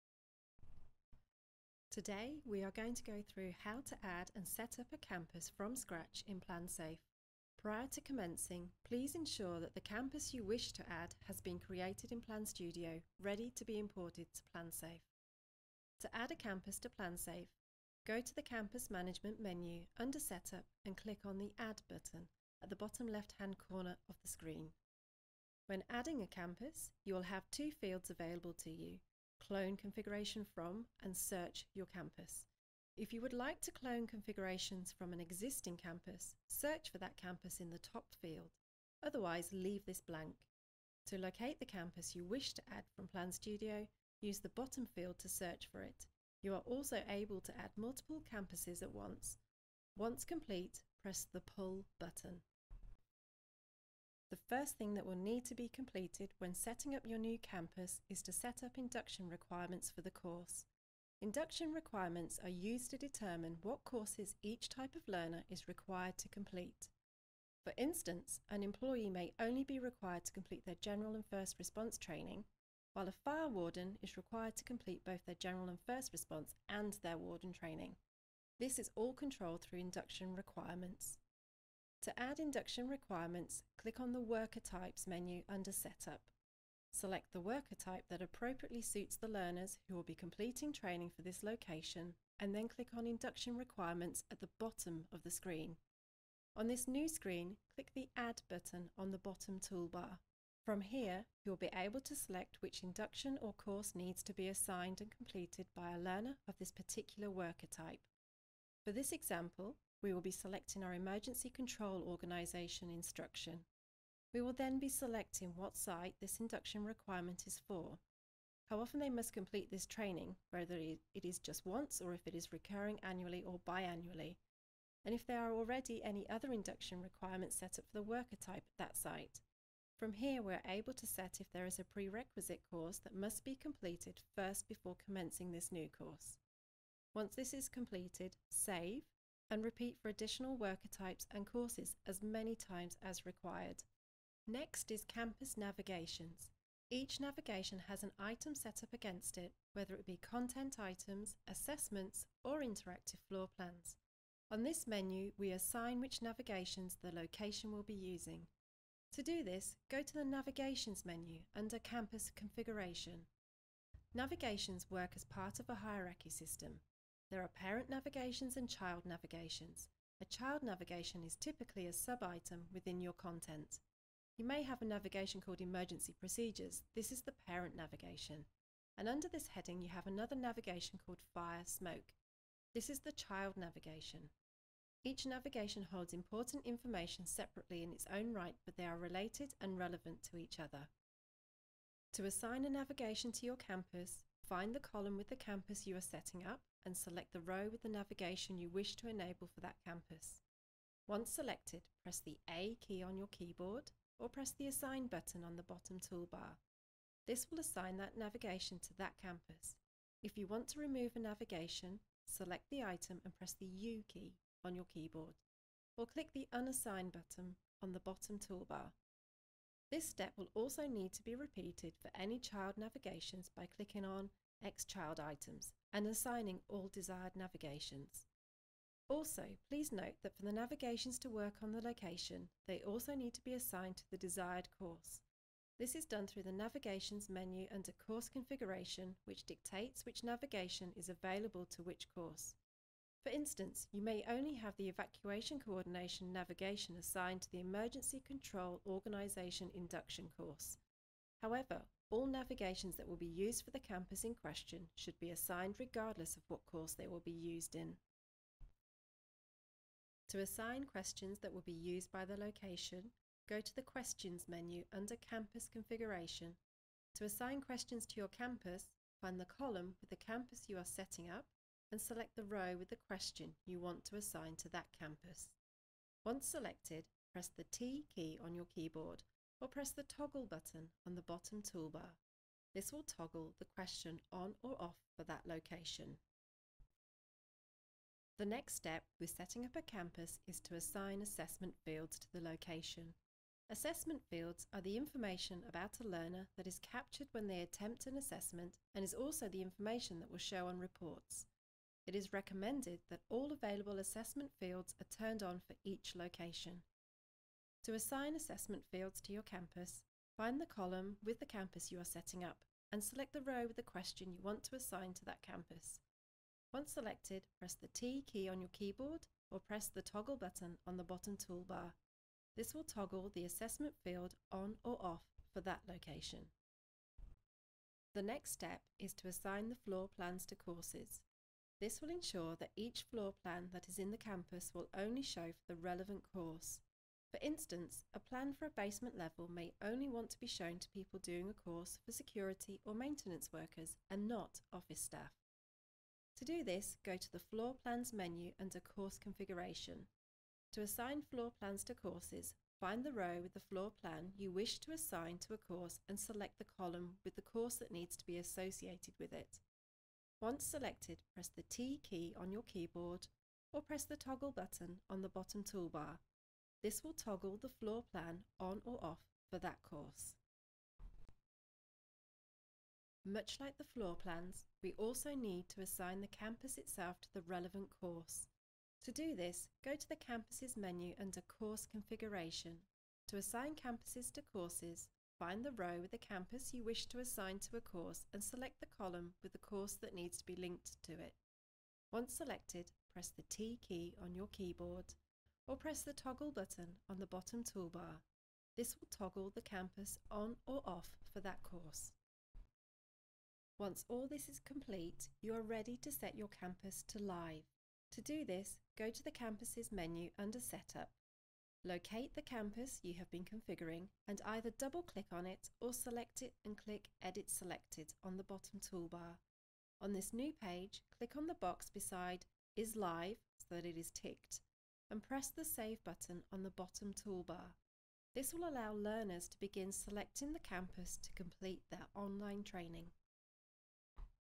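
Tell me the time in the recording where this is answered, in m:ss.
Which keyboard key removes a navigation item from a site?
3:33.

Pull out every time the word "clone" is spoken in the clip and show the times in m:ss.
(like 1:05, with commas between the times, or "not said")
0:29, 0:33.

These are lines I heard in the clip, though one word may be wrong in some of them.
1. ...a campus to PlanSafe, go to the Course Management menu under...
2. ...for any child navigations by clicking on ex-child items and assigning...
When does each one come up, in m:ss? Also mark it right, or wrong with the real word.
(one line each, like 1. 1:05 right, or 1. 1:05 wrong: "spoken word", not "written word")
1. 0:16 wrong: "Campus", not "Course"
2. 3:42 right.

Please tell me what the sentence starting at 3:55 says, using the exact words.
This is done through the Navigations menu under Course Configuration, which dictates which navigation is available to which course.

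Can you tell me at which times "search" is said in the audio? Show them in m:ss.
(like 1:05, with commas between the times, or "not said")
0:31, 0:36, 0:45.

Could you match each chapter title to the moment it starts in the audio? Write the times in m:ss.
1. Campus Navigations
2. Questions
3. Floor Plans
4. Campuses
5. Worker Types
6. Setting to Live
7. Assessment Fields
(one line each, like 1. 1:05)
1. 2:23
2. 4:18
3. 5:27
4. 6:11
5. 0:58
6. 6:42
7. 4:46.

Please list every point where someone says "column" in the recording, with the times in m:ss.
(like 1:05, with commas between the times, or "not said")
3:14, 4:29, 5:10, 5:56, 6:28.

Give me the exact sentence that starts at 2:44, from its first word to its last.
Navigations work as part of a hierarchy system, there are parent navigations and child navigations.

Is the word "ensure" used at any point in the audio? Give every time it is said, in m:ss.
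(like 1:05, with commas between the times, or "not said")
0:09, 5:32.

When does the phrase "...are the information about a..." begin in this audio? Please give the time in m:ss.
4:54.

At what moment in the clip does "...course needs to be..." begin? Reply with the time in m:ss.
1:43.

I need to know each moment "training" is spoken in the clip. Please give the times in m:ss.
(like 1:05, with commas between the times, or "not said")
1:11, 1:17, 1:30, 1:59, 7:12.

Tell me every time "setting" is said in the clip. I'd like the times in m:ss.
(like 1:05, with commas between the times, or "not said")
0:56, 3:16, 4:30, 4:49, 5:12.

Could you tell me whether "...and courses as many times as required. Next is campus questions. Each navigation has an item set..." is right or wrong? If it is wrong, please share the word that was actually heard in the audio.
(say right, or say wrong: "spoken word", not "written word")
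wrong: "navigations", not "questions".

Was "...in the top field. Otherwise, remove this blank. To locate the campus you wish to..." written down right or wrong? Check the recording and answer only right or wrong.
wrong.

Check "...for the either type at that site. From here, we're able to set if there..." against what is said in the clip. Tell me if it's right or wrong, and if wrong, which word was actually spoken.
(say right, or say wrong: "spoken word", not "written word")
wrong: "worker", not "either".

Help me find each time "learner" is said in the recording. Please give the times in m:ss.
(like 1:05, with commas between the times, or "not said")
1:05, 1:29, 1:45, 4:56, 7:08.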